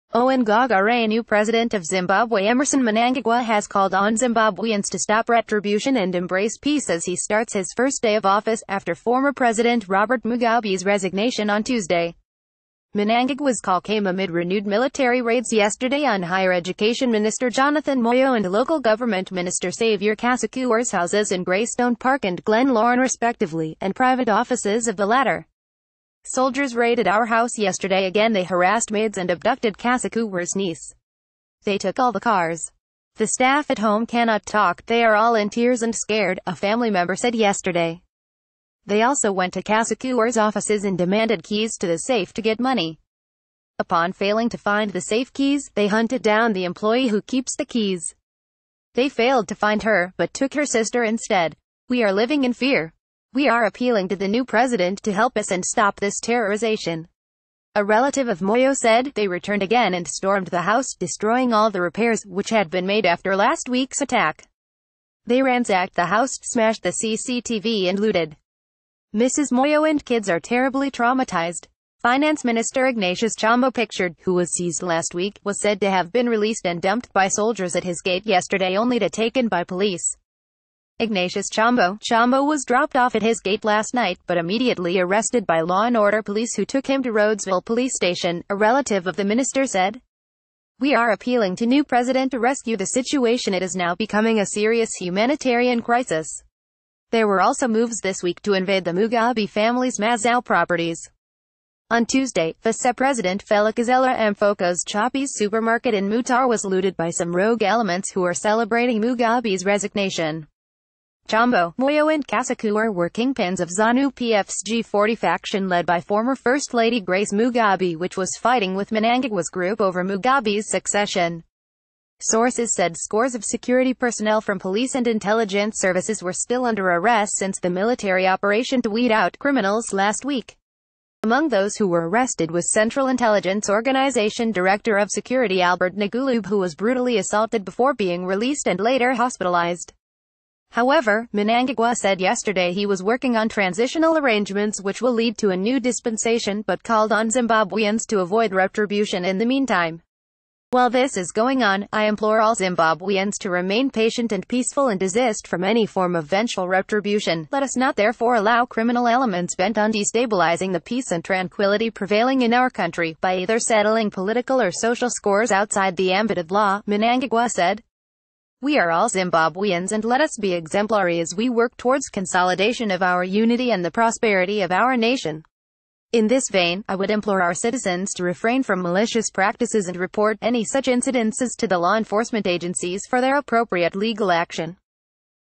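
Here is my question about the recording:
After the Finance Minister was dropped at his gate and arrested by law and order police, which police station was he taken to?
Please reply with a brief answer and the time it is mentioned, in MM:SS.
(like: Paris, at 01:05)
Rhodesville Police Station, at 01:27.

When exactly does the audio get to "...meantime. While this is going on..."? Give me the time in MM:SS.
02:29.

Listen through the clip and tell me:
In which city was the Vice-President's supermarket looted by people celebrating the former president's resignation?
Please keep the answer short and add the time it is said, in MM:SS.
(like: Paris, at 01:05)
Mutare, at 01:46.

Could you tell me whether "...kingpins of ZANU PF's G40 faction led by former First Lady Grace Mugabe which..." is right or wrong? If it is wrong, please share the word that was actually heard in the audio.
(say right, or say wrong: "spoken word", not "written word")
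right.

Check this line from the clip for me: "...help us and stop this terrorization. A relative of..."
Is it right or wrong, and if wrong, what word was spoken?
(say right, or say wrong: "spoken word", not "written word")
right.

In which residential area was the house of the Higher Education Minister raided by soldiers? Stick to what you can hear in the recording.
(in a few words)
Greystone Park.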